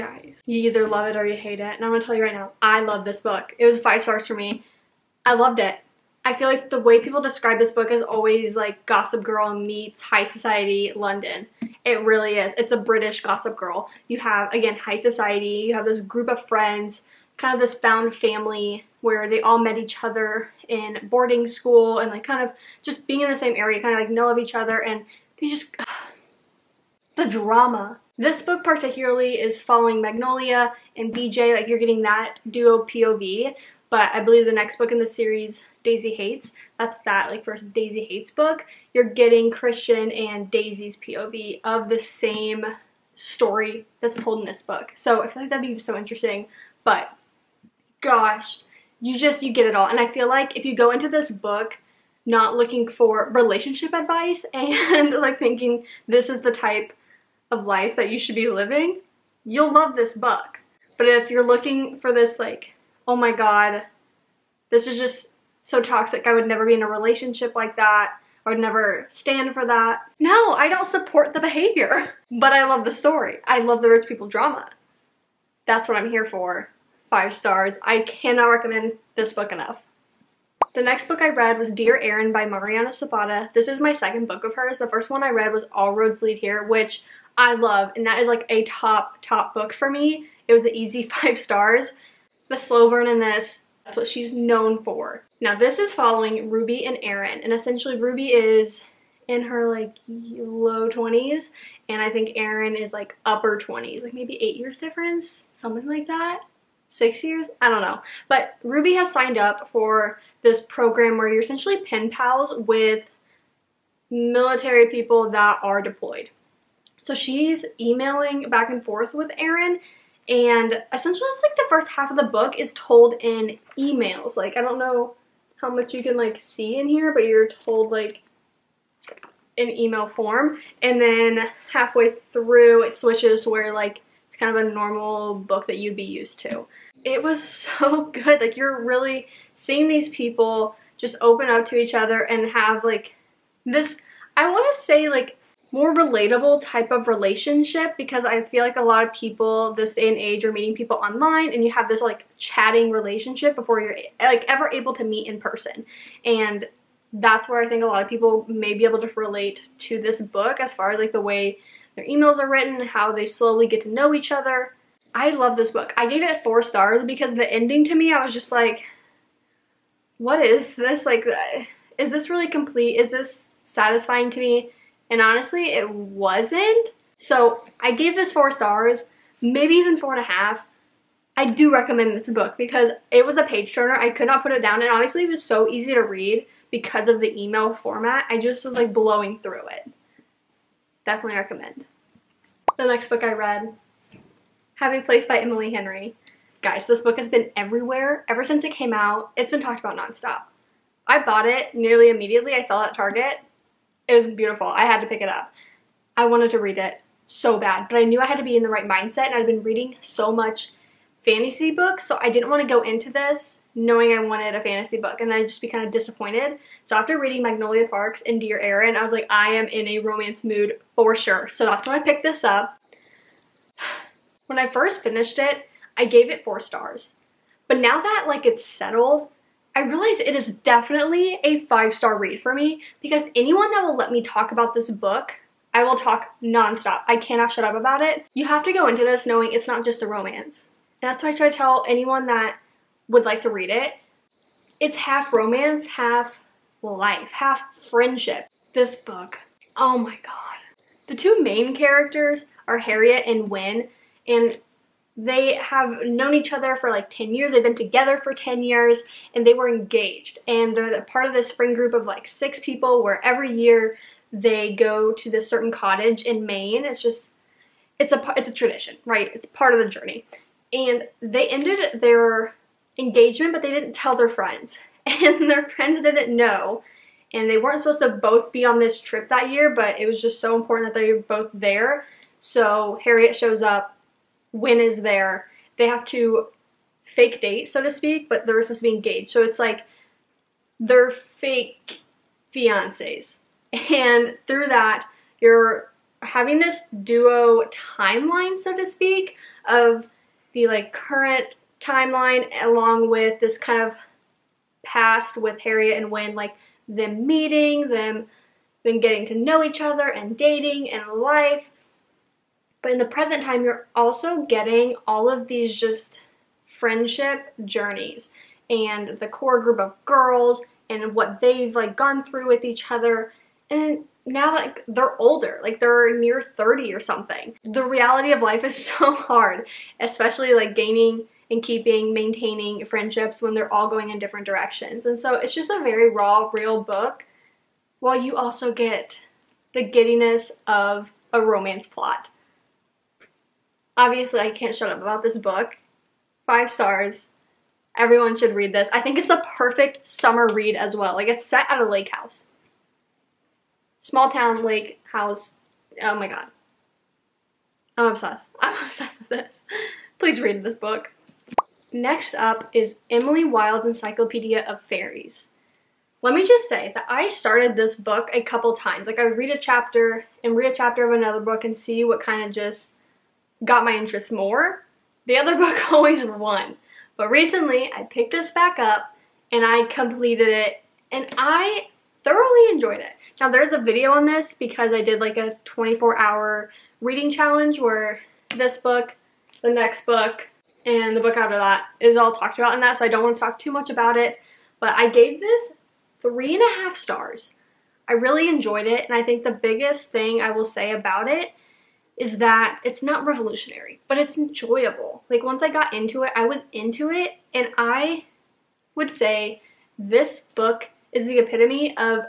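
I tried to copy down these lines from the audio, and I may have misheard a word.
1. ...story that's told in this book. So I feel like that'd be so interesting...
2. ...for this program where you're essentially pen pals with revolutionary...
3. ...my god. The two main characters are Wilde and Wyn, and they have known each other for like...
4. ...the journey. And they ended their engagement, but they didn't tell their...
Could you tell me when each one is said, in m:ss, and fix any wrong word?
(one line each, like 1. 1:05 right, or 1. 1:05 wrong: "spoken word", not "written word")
1. 0:43 right
2. 1:49 wrong: "military", not "revolutionary"
3. 4:09 wrong: "Harriet", not "Wilde"
4. 4:29 right.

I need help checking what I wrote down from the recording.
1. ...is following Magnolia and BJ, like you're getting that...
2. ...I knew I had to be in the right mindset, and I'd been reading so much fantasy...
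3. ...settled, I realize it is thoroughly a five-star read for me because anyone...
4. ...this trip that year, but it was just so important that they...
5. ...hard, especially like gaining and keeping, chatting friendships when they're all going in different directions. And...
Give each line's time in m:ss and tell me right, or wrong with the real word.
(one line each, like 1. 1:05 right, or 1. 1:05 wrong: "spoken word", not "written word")
1. 0:29 right
2. 3:28 right
3. 3:48 wrong: "definitely", not "thoroughly"
4. 4:38 right
5. 5:29 wrong: "maintaining", not "chatting".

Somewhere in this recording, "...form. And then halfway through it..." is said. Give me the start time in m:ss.
2:10.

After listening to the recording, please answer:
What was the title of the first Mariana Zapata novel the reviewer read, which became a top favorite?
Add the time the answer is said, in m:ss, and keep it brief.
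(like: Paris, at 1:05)
All Roads Lead Here, at 1:25.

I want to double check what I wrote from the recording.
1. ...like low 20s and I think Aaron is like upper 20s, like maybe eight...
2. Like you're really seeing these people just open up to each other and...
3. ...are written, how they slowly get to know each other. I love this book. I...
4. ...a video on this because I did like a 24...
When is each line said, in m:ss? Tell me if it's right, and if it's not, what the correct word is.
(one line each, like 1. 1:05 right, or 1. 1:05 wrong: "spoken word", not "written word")
1. 1:39 right
2. 2:18 right
3. 2:42 right
4. 6:23 right.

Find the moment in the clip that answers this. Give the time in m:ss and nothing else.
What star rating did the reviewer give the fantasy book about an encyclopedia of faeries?
6:36.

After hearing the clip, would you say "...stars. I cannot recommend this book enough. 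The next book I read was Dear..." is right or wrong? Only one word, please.
right.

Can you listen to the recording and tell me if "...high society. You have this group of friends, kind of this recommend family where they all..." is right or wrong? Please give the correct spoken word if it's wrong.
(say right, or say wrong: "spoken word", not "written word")
wrong: "found", not "recommend".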